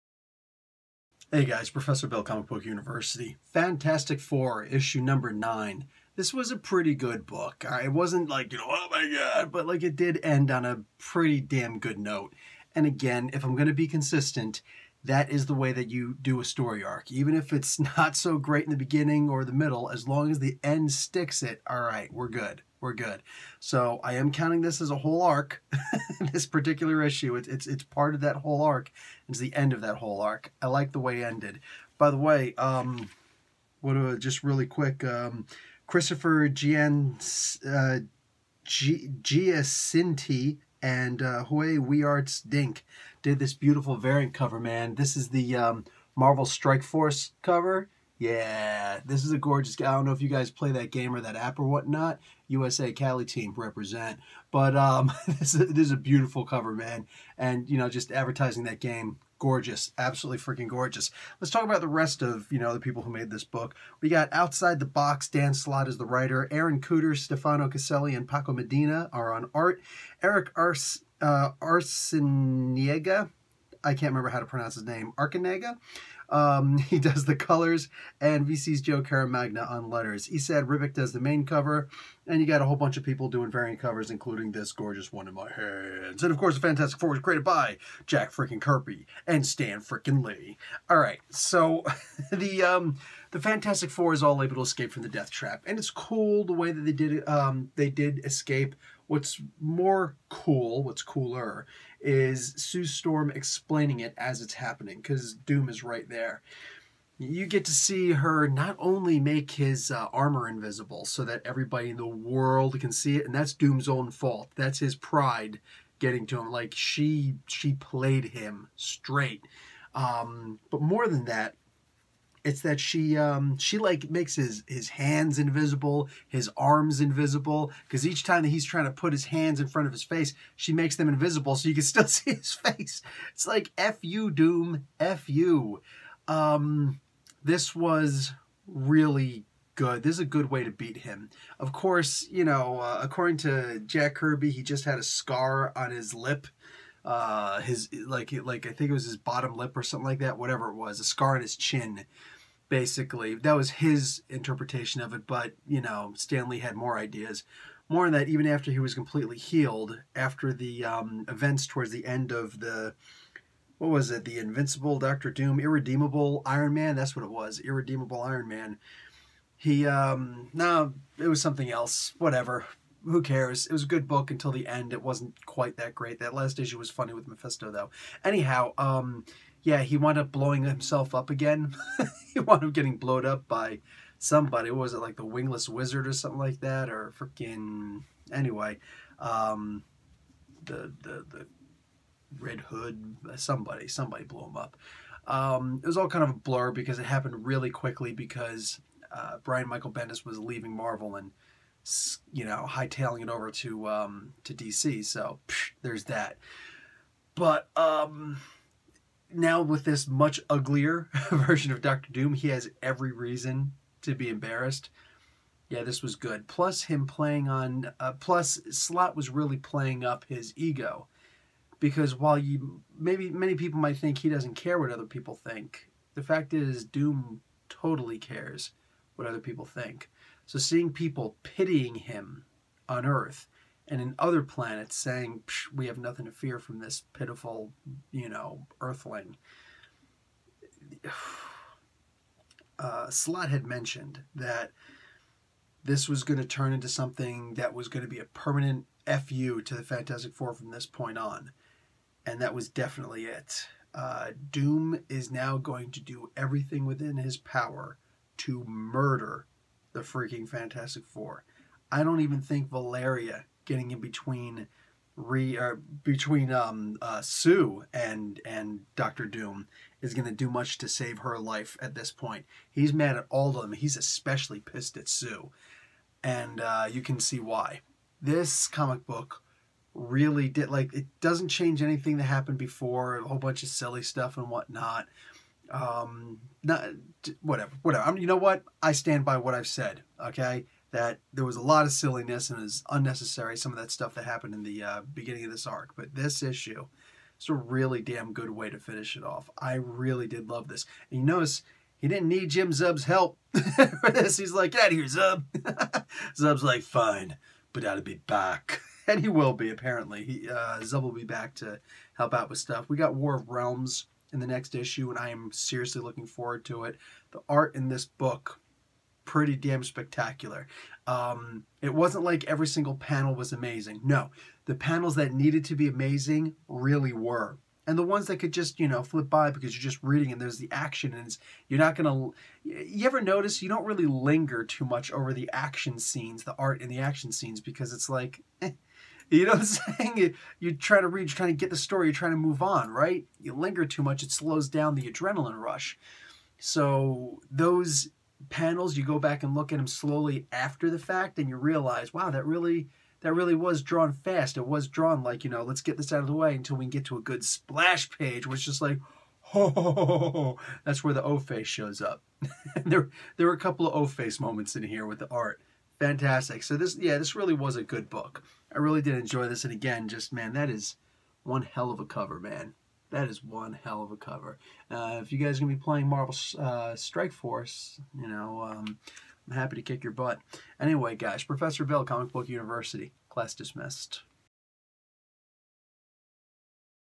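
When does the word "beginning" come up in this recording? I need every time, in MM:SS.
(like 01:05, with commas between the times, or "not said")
00:18, 04:55.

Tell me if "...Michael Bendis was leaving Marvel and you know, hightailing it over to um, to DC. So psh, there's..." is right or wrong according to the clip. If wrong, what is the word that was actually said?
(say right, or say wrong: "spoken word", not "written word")
right.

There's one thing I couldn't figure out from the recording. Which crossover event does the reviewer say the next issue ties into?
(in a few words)
War of Realms.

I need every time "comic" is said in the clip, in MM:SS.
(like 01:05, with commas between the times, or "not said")
00:02, 04:38, 06:22.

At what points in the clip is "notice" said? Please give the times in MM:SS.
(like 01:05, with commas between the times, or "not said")
05:01, 05:33.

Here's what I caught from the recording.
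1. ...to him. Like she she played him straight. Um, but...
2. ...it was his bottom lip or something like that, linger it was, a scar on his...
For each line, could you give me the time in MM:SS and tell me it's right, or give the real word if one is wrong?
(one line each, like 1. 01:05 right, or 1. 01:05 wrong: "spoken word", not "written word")
1. 01:56 right
2. 02:28 wrong: "whatever", not "linger".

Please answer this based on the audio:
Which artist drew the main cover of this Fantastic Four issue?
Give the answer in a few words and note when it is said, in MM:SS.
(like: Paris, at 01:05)
Esad Ribic, at 01:20.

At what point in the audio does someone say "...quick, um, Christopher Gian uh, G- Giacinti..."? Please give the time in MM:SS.
00:34.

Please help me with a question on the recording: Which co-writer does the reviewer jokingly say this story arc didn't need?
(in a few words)
Jim Zub.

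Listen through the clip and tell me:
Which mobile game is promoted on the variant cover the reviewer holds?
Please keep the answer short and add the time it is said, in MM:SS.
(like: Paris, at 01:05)
Marvel Strike Force, at 00:46.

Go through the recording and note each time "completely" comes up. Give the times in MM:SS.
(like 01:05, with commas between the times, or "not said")
02:38.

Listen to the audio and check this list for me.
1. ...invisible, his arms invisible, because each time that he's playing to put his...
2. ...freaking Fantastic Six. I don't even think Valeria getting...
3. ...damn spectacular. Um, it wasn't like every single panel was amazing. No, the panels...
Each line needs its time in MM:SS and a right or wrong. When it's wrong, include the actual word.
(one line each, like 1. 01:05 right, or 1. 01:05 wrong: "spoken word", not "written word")
1. 02:05 wrong: "trying", not "playing"
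2. 04:20 wrong: "Four", not "Six"
3. 05:19 right.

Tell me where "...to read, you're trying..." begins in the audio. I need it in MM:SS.
05:41.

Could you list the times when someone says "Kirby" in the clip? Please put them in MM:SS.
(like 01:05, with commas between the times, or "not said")
01:28, 02:24.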